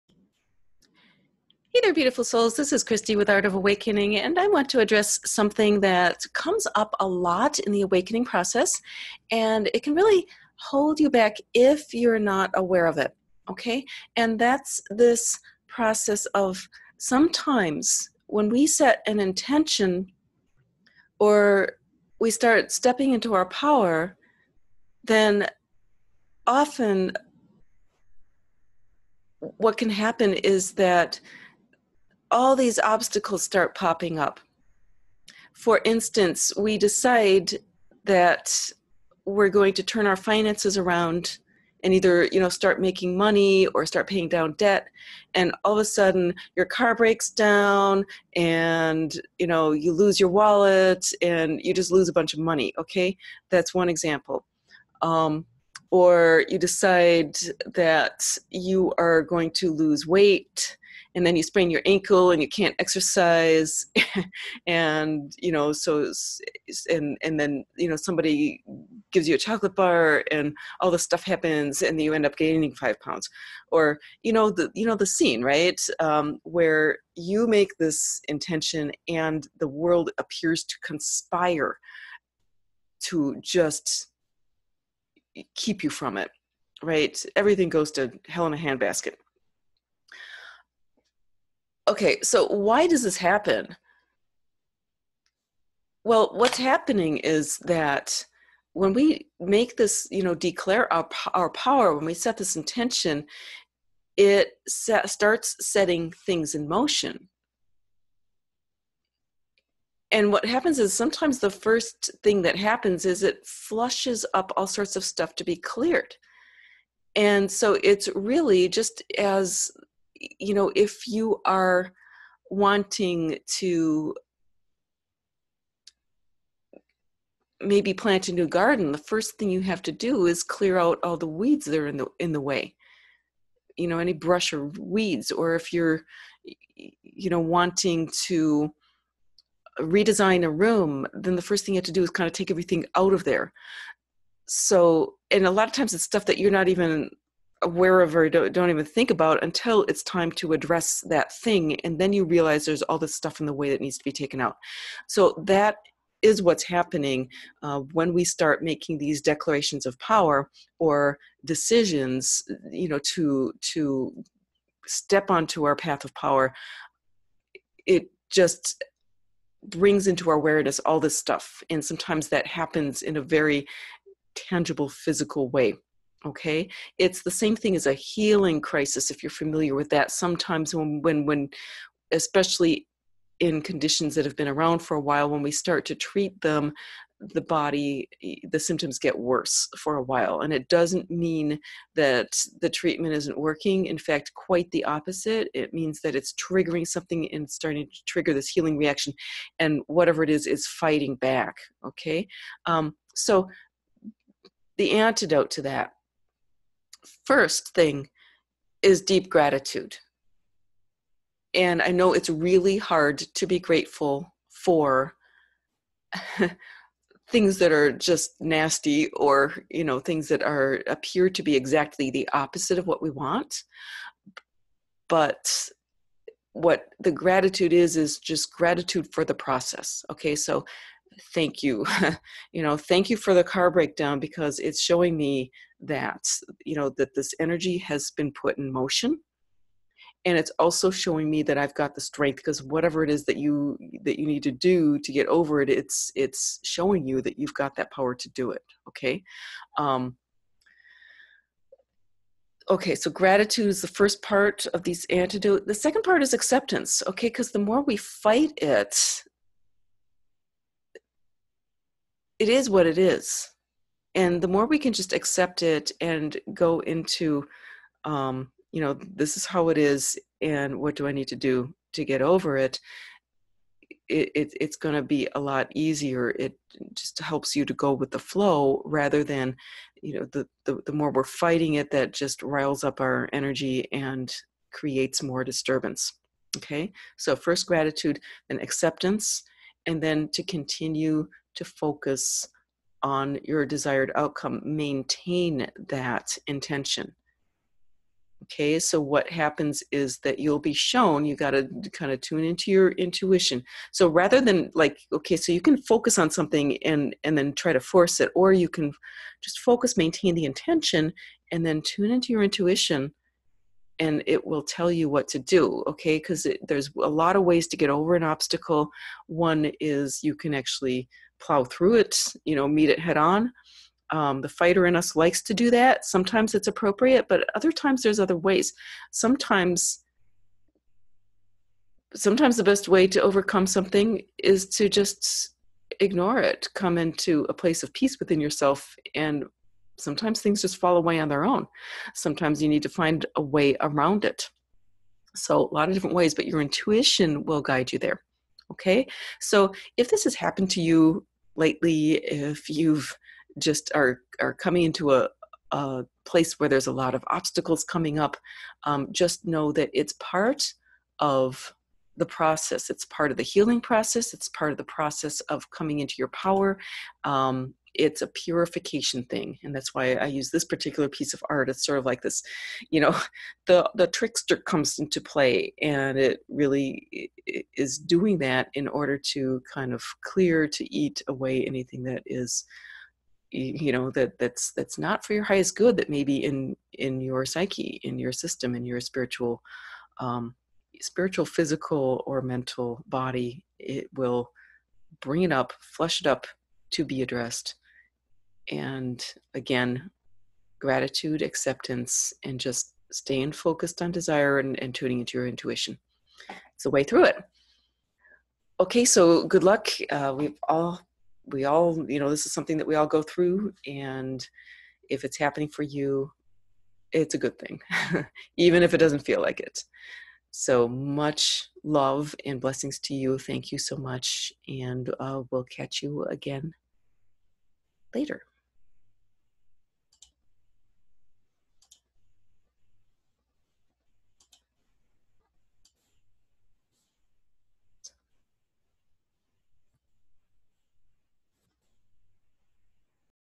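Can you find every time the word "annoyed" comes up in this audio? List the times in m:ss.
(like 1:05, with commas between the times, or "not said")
not said.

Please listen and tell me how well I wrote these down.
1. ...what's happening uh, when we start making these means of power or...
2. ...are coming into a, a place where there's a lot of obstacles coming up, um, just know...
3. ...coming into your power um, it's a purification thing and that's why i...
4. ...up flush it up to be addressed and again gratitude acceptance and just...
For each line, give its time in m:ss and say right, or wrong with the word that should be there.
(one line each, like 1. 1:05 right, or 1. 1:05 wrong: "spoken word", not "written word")
1. 2:36 wrong: "declarations", not "means"
2. 5:54 right
3. 6:05 right
4. 6:35 right.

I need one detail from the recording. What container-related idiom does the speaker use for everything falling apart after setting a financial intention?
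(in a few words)
hell in a handbasket.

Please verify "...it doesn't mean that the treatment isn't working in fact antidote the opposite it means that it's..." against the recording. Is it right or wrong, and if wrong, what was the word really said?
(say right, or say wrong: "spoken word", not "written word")
wrong: "quite", not "antidote".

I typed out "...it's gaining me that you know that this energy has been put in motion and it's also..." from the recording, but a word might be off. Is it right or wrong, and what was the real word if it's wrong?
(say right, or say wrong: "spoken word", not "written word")
wrong: "showing", not "gaining".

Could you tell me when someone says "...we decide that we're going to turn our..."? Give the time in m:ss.
0:36.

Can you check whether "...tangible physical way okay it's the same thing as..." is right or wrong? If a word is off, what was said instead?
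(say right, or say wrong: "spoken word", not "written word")
right.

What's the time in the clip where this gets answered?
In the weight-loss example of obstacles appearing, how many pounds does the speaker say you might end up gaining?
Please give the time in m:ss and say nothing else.
1:12.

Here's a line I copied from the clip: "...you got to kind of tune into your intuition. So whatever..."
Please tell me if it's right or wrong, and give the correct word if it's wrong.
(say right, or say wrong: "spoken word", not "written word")
wrong: "rather", not "whatever".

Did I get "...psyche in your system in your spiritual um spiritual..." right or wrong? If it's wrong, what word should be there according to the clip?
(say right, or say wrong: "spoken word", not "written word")
right.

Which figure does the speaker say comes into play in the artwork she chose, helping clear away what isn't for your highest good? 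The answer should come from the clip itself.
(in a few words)
the trickster.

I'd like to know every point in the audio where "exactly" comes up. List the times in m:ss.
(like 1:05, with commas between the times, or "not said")
3:41.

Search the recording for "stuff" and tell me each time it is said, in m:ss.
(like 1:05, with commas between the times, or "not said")
1:11, 1:55, 2:26, 2:33, 2:51.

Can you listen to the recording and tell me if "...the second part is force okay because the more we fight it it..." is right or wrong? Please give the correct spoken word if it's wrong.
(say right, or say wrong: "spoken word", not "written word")
wrong: "acceptance", not "force".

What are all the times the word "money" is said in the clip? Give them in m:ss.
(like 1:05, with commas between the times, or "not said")
0:43, 0:52.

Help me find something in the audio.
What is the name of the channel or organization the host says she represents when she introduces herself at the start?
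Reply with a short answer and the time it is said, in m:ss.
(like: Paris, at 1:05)
Art of Awakening, at 0:03.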